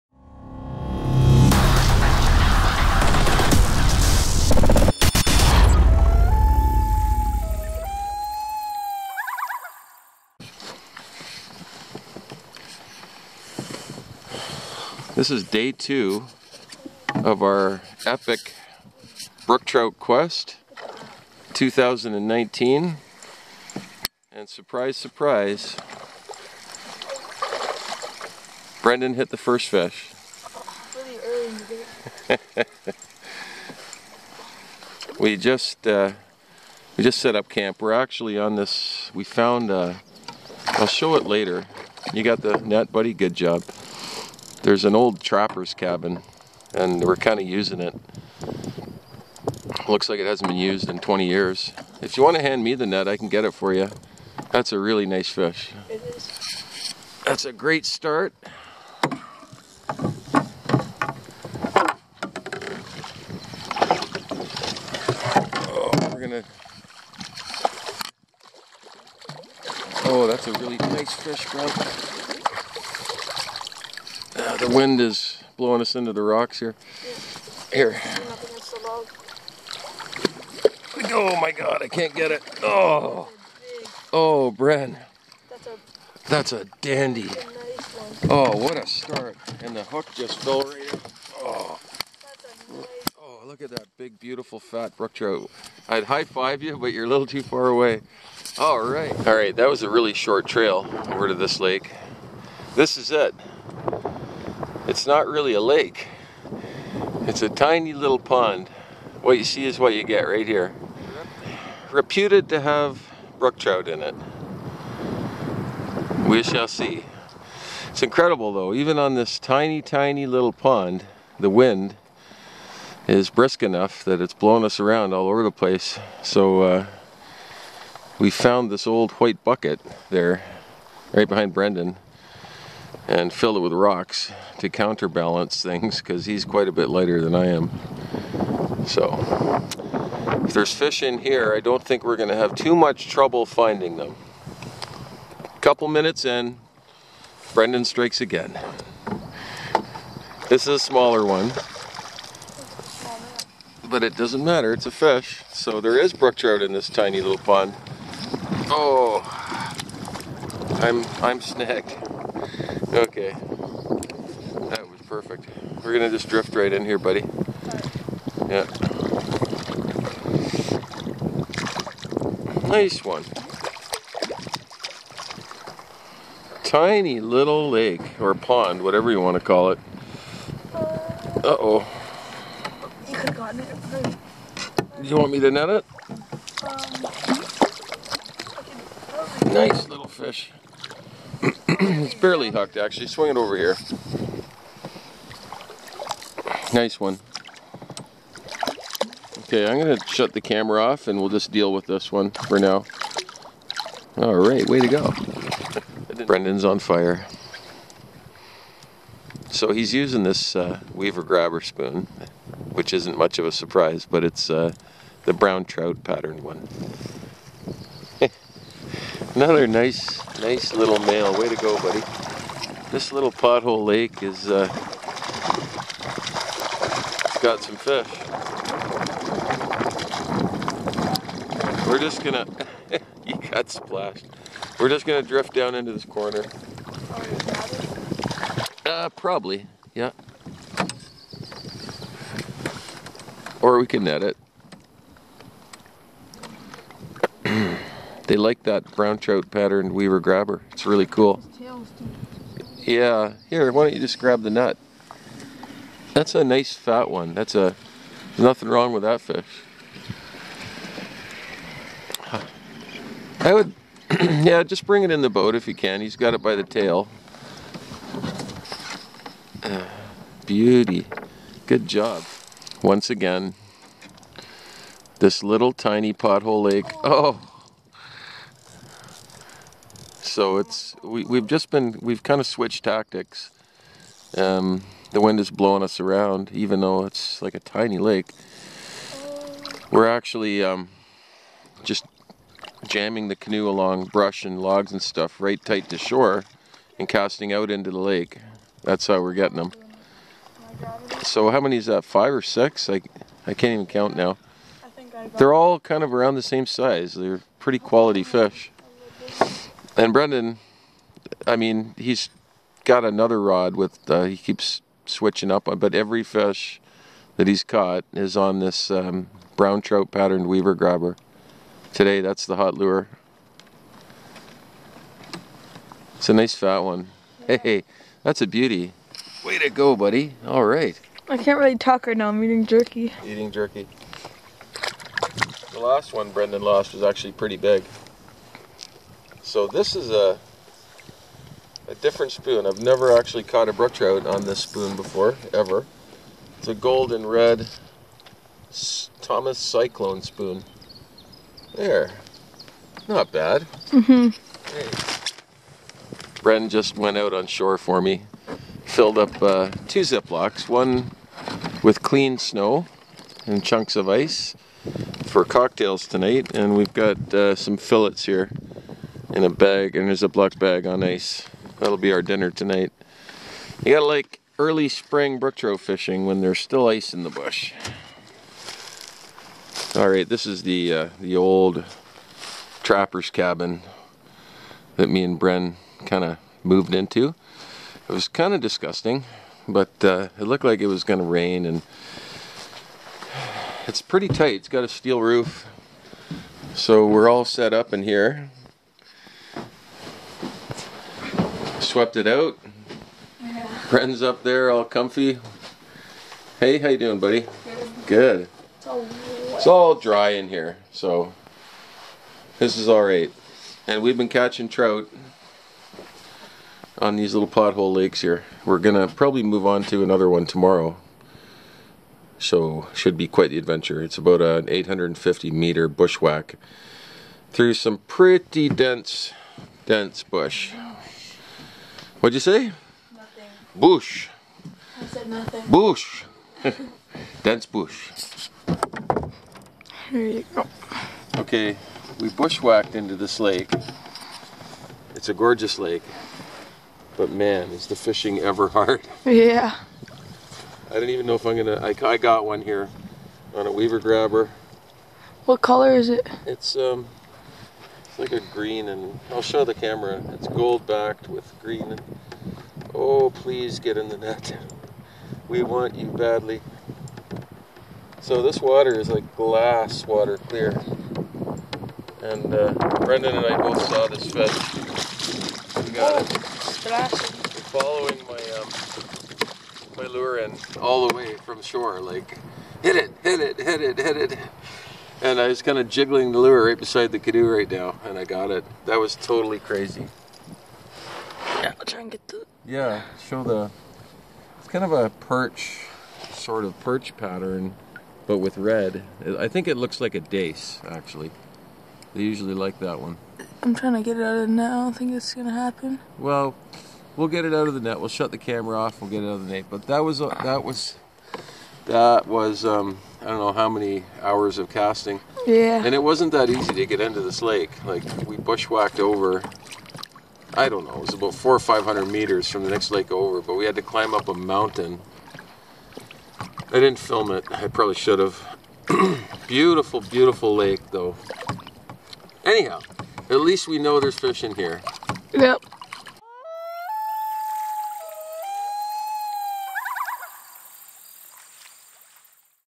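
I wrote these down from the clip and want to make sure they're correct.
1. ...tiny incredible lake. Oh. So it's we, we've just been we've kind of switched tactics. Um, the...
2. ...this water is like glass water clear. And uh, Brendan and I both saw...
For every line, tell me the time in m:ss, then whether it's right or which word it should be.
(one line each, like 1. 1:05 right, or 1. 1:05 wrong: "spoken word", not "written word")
1. 4:35 wrong: "pothole", not "incredible"
2. 7:48 right.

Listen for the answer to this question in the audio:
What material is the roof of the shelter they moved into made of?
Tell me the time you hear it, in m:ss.
6:34.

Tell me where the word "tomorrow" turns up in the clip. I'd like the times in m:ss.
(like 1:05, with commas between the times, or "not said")
7:00.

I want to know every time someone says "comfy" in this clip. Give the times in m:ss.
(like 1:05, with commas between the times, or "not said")
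6:44.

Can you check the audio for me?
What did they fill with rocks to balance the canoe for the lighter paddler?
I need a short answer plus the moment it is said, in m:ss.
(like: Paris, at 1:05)
White bucket, at 2:08.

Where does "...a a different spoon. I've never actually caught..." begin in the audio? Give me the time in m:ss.
5:40.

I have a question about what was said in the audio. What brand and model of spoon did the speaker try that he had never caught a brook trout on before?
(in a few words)
Thomas Cyclone.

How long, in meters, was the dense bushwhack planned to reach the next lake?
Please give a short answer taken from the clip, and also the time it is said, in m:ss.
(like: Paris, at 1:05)
850, at 7:04.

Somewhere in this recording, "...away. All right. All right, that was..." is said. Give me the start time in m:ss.
1:37.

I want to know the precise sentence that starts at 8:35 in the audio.
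And it wasn't that easy to get into this lake.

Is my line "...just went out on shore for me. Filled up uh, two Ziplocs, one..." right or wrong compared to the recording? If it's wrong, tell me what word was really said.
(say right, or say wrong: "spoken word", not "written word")
right.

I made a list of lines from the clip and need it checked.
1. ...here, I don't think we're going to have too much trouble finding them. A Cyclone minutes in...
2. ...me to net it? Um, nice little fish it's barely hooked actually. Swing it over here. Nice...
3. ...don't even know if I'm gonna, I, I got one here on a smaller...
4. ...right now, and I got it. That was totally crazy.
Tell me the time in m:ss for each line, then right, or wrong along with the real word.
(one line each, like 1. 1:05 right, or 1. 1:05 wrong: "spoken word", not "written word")
1. 2:21 wrong: "Couple", not "Cyclone"
2. 3:05 right
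3. 7:30 wrong: "weaver", not "smaller"
4. 8:07 right.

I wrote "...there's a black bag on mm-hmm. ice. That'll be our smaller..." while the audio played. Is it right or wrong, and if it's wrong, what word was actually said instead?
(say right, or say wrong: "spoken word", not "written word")
wrong: "dinner", not "smaller".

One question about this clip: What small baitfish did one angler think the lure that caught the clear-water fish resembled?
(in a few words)
Dace.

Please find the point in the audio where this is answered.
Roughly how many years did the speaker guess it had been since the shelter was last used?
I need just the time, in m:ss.
0:50.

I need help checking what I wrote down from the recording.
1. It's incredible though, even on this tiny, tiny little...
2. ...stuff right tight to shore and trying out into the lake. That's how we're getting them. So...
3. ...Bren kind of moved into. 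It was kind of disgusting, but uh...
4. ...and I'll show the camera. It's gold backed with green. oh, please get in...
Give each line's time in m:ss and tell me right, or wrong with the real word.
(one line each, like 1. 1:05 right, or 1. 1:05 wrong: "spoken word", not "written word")
1. 1:57 right
2. 4:55 wrong: "casting", not "trying"
3. 6:25 right
4. 7:38 right.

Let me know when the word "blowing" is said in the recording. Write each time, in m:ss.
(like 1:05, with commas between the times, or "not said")
1:15, 2:04, 4:45.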